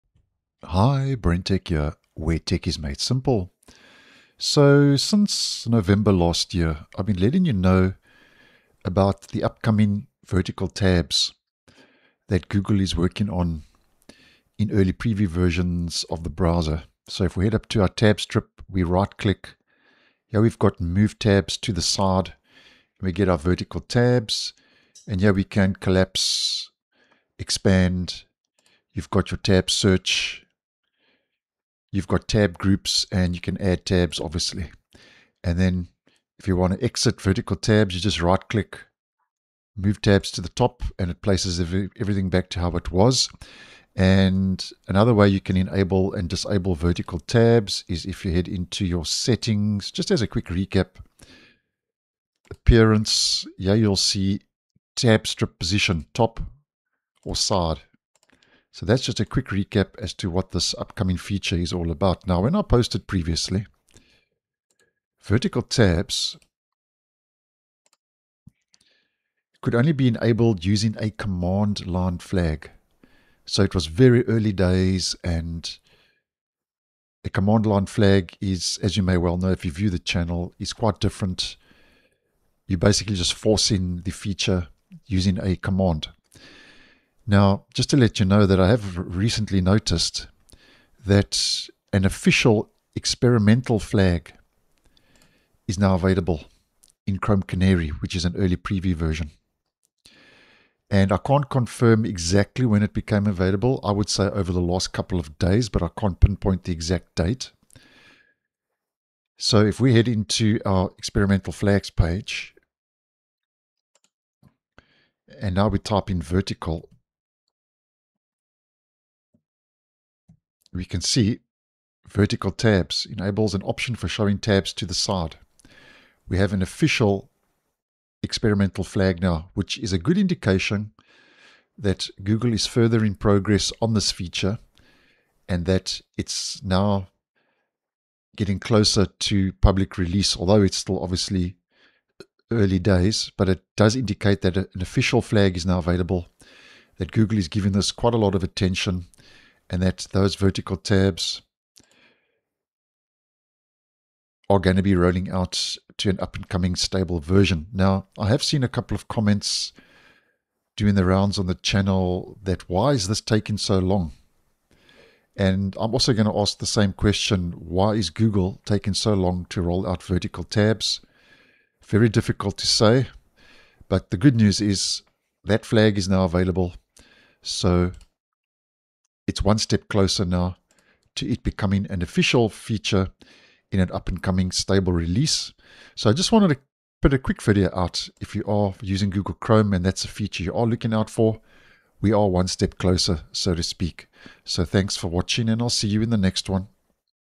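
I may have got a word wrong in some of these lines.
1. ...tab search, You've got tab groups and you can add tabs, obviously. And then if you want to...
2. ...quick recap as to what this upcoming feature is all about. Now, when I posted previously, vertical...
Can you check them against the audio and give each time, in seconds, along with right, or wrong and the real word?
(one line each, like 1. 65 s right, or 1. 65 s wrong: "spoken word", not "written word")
1. 29 s right
2. 59 s right.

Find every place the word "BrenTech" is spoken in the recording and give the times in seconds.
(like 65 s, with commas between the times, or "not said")
1 s.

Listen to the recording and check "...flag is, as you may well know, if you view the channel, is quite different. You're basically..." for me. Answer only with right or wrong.
right.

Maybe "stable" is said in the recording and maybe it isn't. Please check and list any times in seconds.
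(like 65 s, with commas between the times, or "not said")
156 s, 184 s.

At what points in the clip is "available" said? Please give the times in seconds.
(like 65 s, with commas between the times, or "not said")
95 s, 103 s, 145 s, 176 s.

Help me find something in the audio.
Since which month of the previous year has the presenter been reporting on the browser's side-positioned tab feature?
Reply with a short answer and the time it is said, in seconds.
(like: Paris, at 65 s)
November, at 5 s.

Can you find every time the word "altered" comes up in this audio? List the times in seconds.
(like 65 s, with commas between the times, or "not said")
not said.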